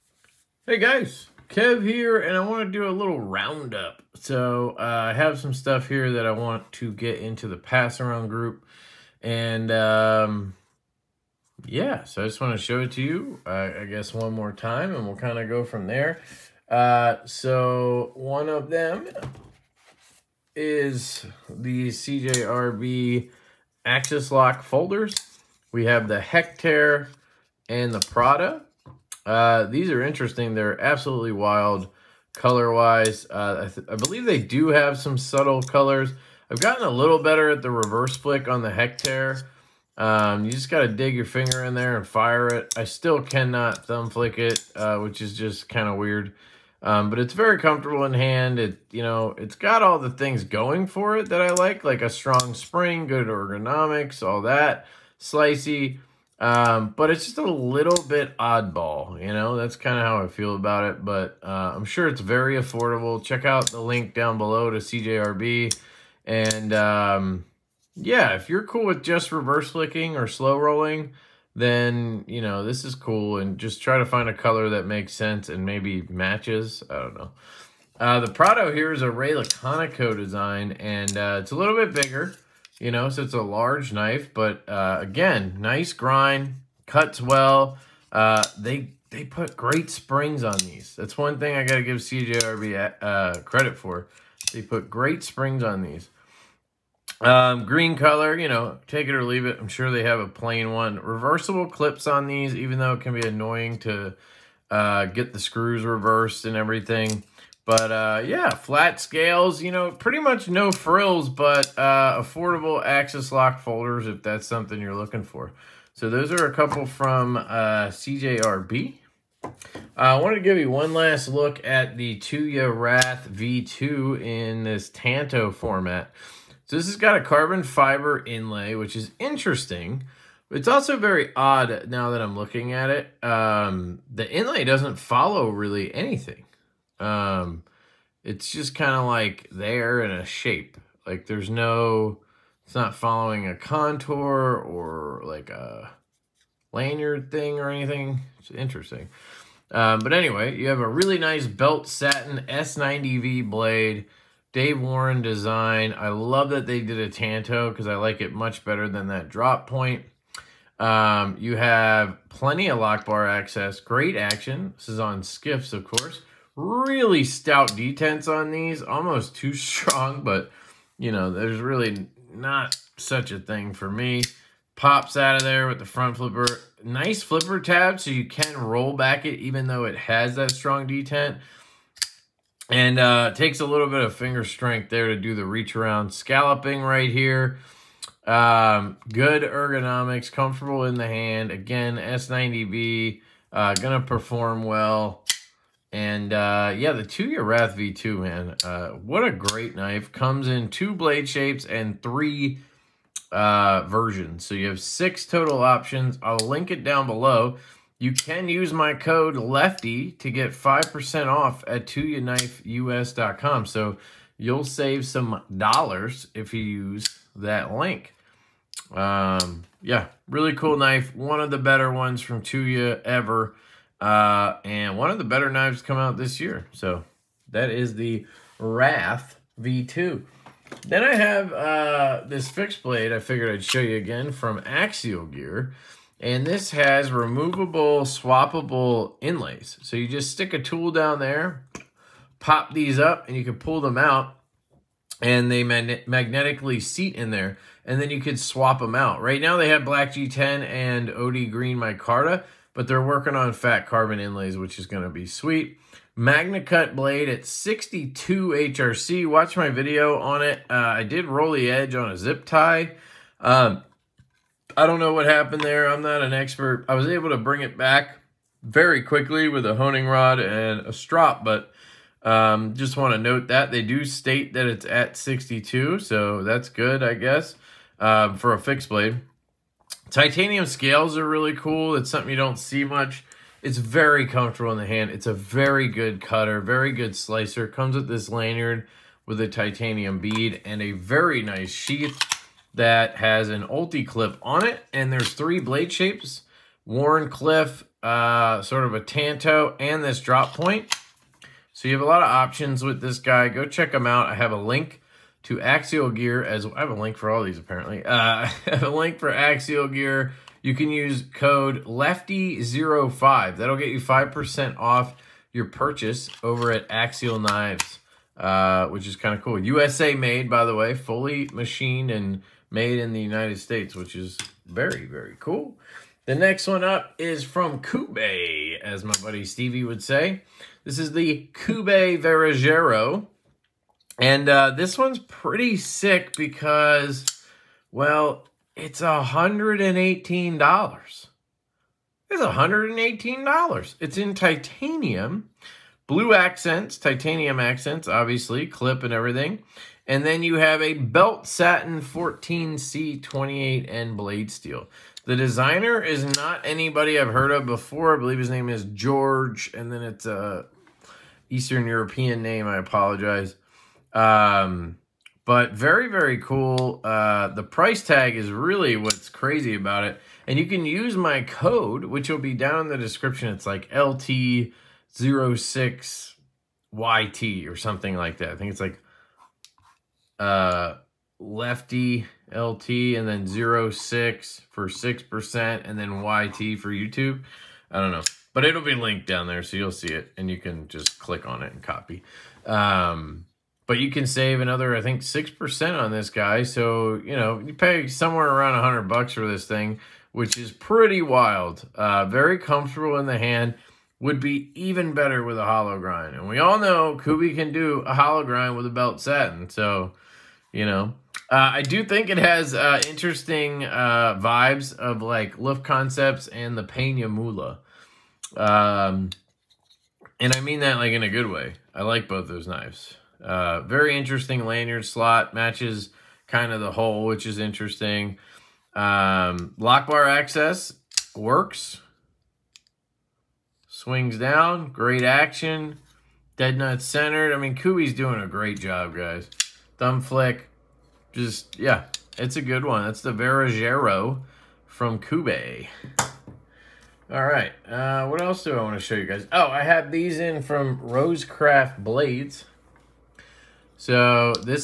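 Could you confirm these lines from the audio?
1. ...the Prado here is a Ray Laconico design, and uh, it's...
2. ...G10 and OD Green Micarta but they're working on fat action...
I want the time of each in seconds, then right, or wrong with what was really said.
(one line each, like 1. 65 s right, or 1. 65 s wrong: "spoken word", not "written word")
1. 78 s right
2. 250 s wrong: "carbon", not "action".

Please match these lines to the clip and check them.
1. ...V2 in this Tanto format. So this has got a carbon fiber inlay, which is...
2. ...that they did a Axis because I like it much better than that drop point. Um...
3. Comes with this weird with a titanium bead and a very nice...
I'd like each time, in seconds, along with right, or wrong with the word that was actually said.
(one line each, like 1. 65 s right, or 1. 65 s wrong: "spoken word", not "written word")
1. 123 s right
2. 156 s wrong: "Tanto", not "Axis"
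3. 287 s wrong: "lanyard", not "weird".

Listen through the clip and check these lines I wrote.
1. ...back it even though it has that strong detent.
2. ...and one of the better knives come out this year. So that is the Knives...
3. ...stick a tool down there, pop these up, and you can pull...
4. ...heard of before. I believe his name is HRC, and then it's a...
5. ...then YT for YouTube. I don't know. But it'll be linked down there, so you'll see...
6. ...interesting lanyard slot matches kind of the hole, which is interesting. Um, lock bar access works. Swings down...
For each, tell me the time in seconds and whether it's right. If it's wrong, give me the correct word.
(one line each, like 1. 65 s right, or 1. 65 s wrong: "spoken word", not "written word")
1. 178 s right
2. 224 s wrong: "Wrath", not "Knives"
3. 240 s right
4. 357 s wrong: "George", not "HRC"
5. 385 s right
6. 424 s right.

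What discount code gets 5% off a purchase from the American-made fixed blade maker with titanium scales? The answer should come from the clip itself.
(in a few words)
LEFTY05.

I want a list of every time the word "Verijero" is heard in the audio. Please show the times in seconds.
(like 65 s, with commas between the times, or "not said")
332 s, 443 s.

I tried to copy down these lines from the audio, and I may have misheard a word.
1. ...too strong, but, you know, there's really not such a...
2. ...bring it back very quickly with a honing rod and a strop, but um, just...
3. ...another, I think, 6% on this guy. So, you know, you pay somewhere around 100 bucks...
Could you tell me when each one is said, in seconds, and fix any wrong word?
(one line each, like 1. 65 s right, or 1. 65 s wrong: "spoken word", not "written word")
1. 169 s right
2. 267 s right
3. 394 s right.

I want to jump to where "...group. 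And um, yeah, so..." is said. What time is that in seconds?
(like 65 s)
8 s.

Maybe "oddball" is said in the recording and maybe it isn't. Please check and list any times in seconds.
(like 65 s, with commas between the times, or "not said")
58 s.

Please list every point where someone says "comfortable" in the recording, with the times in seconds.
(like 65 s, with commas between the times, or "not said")
47 s, 190 s, 284 s, 402 s.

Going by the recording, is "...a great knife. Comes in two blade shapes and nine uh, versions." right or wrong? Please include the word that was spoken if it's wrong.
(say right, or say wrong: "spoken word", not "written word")
wrong: "three", not "nine".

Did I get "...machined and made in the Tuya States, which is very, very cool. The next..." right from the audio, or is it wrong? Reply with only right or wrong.
wrong.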